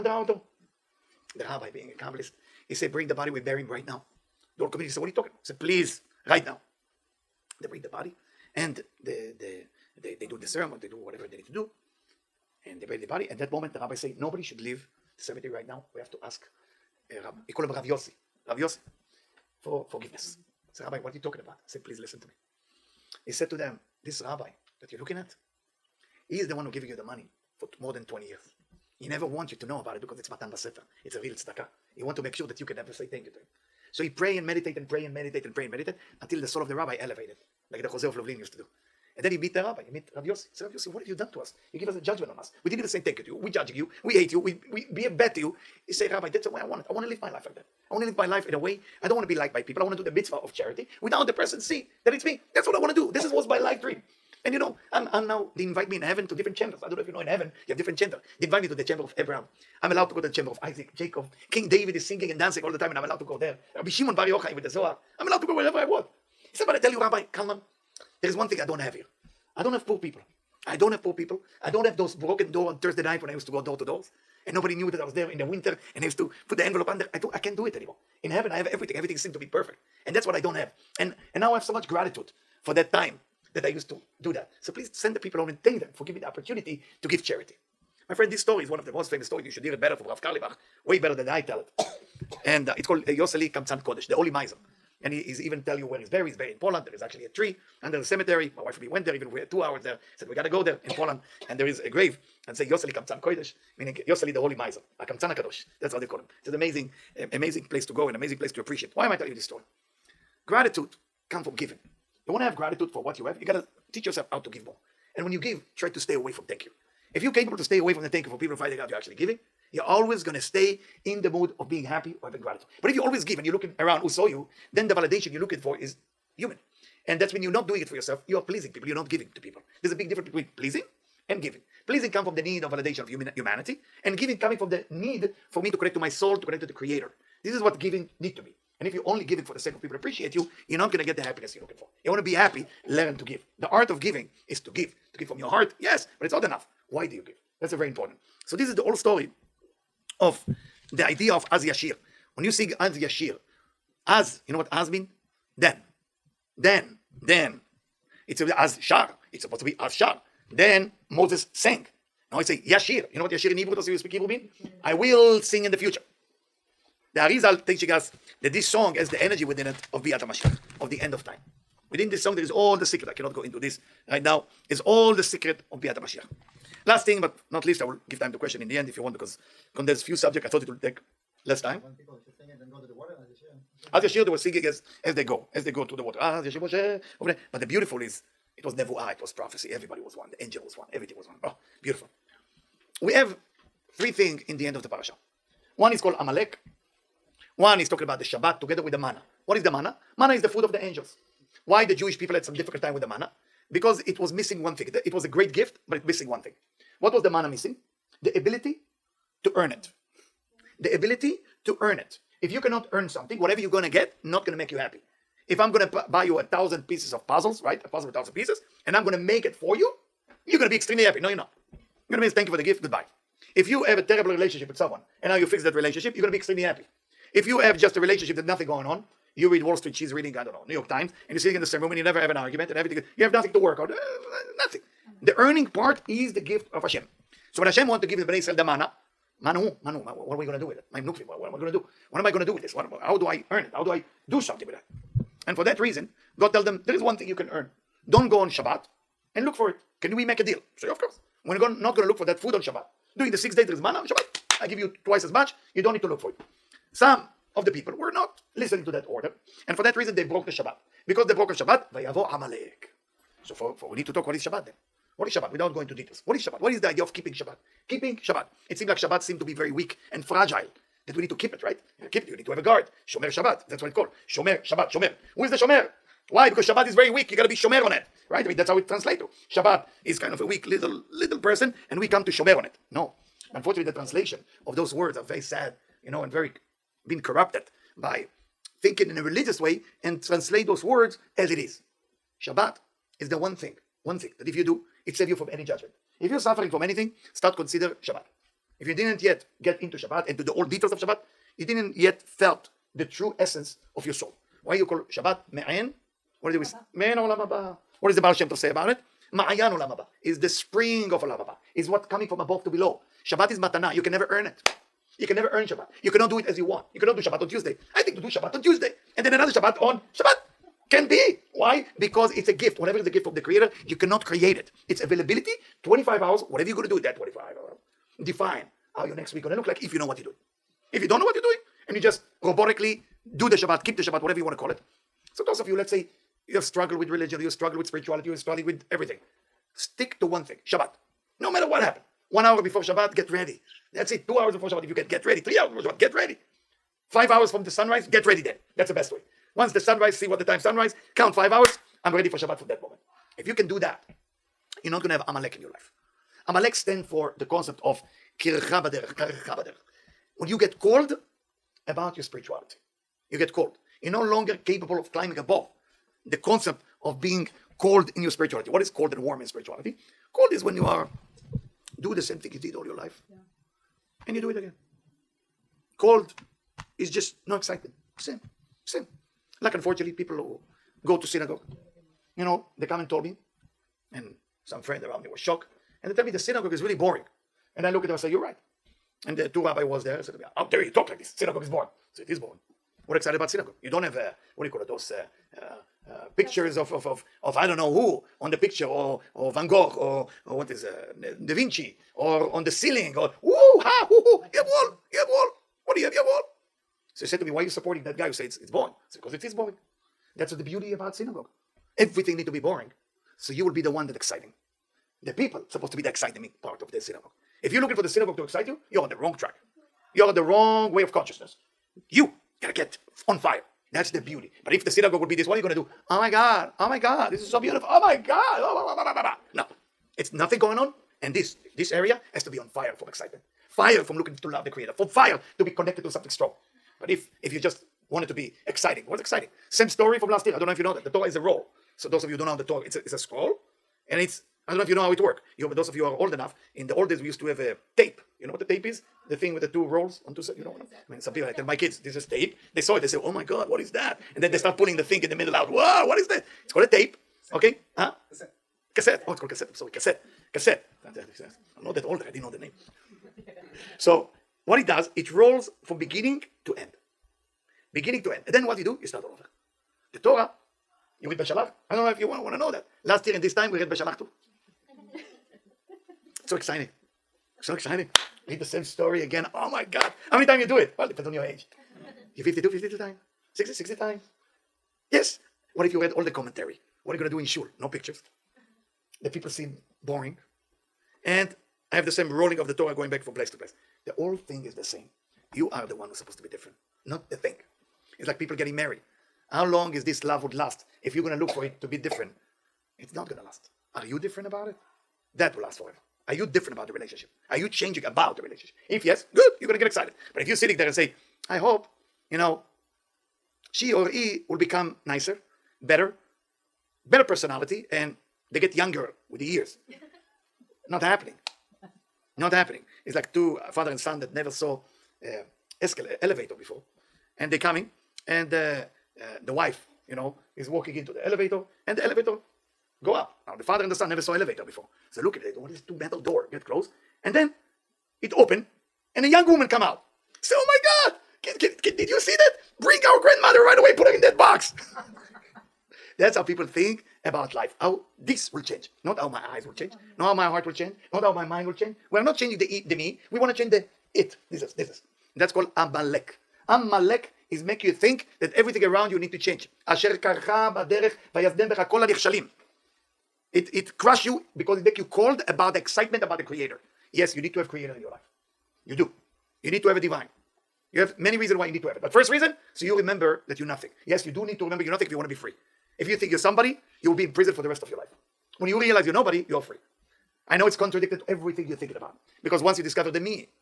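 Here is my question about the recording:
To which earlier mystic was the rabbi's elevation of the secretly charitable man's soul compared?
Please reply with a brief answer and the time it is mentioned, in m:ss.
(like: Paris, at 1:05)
Chozeh of Lublin, at 0:37.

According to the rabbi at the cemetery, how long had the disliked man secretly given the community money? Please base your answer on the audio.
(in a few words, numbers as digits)
more than 20 years.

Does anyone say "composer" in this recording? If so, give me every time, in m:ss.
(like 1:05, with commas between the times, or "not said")
not said.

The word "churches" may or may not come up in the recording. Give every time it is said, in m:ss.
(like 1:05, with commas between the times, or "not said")
not said.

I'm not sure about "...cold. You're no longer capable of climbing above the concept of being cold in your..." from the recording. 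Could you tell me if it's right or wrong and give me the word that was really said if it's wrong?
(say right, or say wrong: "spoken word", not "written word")
right.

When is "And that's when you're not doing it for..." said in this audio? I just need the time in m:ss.
2:07.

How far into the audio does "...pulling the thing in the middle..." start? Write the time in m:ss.
7:34.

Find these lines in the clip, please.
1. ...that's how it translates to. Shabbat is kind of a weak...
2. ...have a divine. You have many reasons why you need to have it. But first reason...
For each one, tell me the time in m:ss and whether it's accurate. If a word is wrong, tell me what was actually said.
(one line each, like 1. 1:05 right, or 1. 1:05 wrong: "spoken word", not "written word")
1. 4:38 right
2. 9:29 right.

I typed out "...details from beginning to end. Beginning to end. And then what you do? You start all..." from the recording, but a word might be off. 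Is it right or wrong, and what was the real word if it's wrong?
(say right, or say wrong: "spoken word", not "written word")
wrong: "rolls", not "details".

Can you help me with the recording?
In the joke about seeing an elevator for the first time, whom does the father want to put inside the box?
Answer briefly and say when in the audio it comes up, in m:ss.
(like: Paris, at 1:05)
Grandmother, at 9:02.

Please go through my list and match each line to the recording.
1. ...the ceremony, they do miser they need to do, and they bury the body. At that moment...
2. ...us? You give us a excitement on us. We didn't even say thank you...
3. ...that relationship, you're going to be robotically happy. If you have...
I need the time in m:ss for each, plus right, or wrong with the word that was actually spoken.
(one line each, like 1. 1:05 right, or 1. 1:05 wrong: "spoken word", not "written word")
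1. 0:10 wrong: "whatever", not "miser"
2. 0:41 wrong: "judgment", not "excitement"
3. 3:45 wrong: "extremely", not "robotically".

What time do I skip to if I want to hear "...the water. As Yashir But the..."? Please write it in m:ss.
3:05.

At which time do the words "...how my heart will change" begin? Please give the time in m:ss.
9:10.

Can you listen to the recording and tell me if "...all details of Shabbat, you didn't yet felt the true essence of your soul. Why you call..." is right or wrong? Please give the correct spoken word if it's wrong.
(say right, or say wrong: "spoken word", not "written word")
right.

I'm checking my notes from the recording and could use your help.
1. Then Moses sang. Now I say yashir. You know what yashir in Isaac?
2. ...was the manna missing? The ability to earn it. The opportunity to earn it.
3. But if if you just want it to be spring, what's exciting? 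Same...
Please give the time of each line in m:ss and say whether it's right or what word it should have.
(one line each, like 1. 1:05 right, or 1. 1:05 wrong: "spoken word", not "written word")
1. 2:40 wrong: "Hebrew", not "Isaac"
2. 3:27 wrong: "ability", not "opportunity"
3. 7:17 wrong: "exciting", not "spring".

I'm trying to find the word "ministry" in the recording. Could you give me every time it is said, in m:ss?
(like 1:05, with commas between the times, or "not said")
not said.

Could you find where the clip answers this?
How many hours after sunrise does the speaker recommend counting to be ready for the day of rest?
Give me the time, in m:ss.
5:51.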